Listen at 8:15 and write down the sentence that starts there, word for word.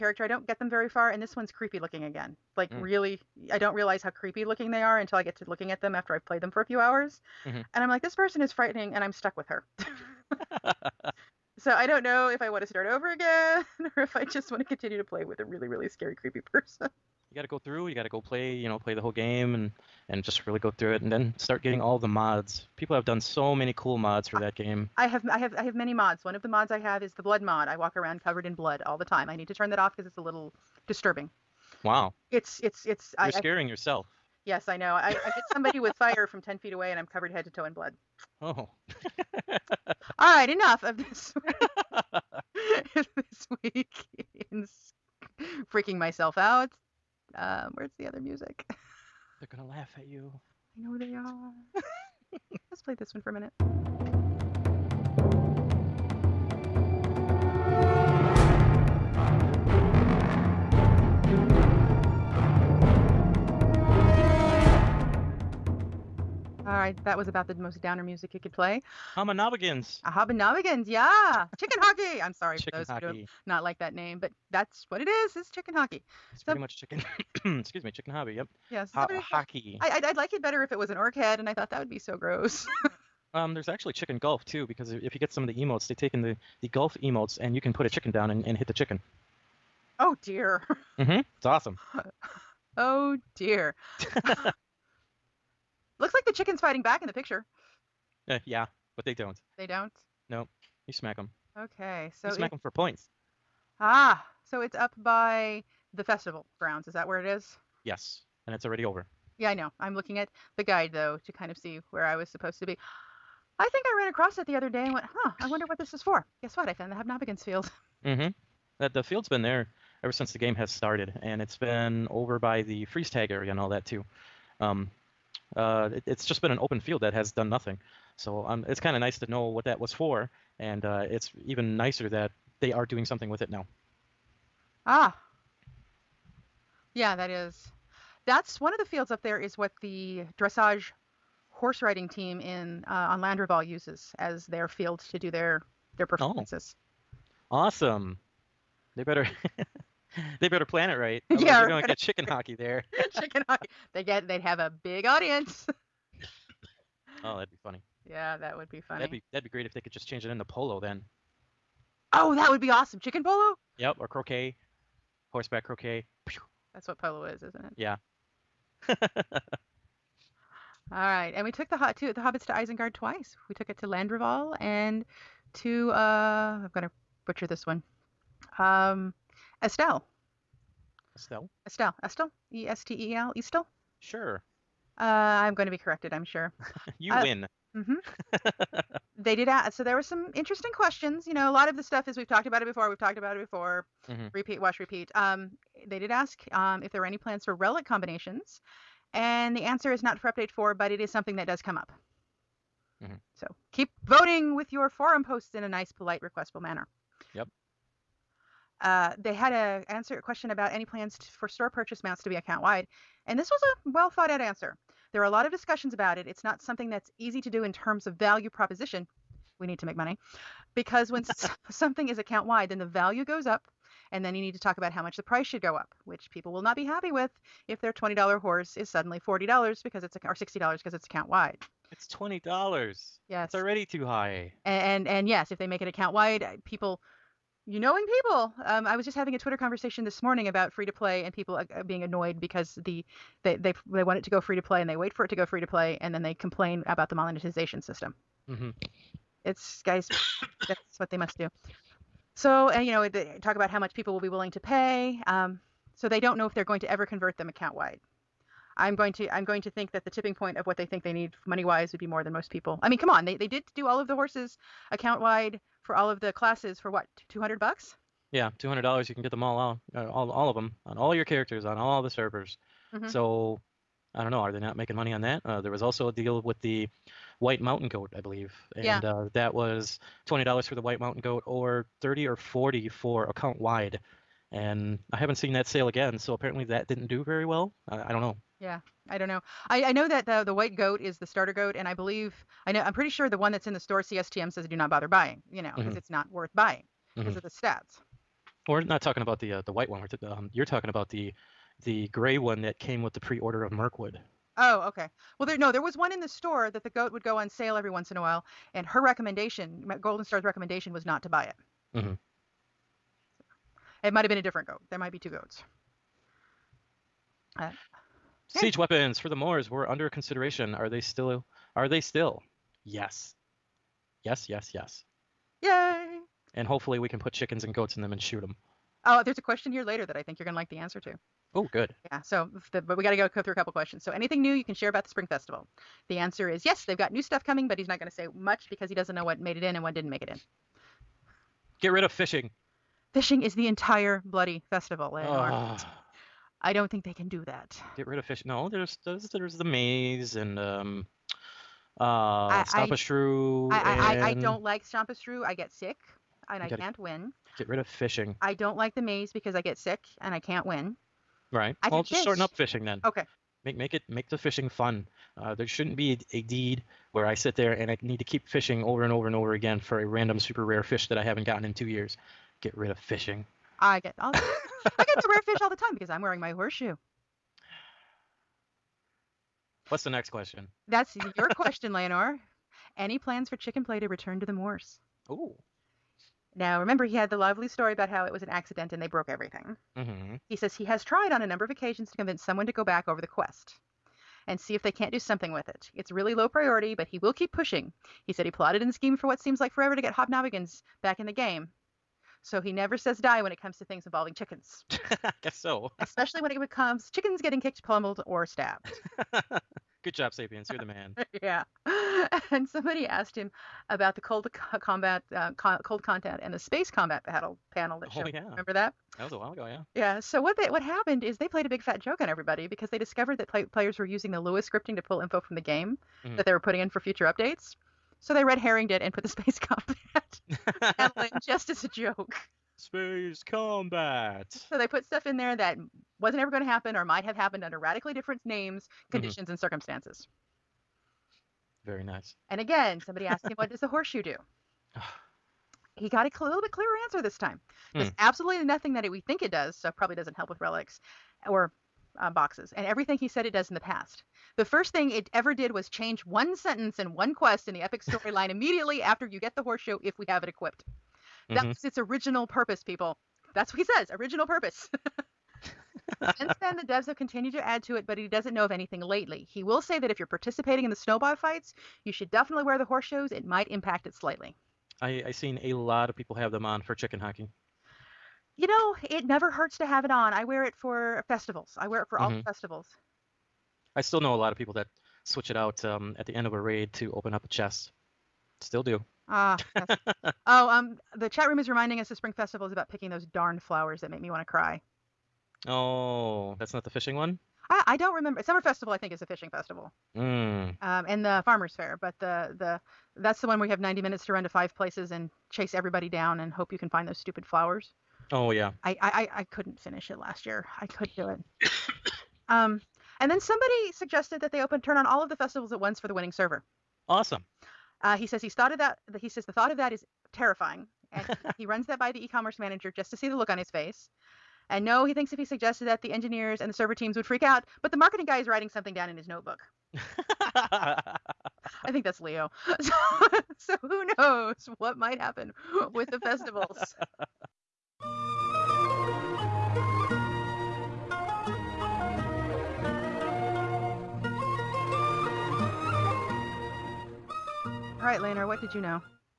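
Oh, that's not the fishing one.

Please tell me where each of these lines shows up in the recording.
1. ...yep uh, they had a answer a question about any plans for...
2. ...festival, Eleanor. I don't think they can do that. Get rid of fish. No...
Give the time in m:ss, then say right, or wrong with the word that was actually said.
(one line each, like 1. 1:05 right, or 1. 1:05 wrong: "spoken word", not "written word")
1. 3:27 right
2. 5:44 right.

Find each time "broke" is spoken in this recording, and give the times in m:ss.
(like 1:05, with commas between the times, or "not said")
6:29.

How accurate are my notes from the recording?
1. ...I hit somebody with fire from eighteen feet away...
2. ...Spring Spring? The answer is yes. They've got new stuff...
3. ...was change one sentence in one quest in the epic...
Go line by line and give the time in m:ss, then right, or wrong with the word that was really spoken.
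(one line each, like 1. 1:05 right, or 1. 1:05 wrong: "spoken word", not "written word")
1. 0:35 wrong: "ten", not "eighteen"
2. 5:35 wrong: "Festival", not "Spring"
3. 7:35 right.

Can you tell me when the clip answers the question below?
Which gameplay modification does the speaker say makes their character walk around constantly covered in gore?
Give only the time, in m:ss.
0:27.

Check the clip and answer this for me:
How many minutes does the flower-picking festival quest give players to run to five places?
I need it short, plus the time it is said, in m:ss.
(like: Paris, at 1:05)
90, at 8:23.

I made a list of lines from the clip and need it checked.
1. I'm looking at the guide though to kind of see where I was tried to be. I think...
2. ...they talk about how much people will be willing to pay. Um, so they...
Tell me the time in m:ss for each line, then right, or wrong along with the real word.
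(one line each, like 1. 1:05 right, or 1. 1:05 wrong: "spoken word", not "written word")
1. 1:49 wrong: "supposed", not "tried"
2. 4:13 right.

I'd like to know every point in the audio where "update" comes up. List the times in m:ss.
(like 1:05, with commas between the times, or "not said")
3:20, 7:07.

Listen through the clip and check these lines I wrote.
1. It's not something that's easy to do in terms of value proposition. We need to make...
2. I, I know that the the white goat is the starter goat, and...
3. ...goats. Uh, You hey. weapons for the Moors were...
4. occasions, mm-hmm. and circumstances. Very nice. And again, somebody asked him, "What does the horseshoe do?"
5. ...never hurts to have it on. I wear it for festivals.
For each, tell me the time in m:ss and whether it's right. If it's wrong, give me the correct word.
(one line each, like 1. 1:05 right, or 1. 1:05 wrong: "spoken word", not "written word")
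1. 3:36 right
2. 4:49 right
3. 5:15 wrong: "Siege", not "You"
4. 7:19 wrong: "conditions", not "occasions"
5. 7:59 right.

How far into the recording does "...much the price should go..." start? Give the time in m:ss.
3:45.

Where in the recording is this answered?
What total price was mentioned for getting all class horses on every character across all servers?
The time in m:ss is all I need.
4:27.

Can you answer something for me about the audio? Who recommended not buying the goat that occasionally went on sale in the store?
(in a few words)
Golden Star.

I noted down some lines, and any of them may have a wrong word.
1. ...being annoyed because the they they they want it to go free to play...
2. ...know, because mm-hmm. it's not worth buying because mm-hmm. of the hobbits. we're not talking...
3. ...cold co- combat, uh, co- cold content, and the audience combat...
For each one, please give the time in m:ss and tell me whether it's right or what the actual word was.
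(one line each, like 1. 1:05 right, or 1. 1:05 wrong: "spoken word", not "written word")
1. 4:01 right
2. 4:55 wrong: "stats", not "hobbits"
3. 6:54 wrong: "space", not "audience".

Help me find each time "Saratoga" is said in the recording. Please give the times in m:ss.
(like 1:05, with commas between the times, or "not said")
not said.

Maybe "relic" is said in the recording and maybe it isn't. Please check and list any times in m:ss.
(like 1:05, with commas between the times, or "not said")
3:17, 7:30.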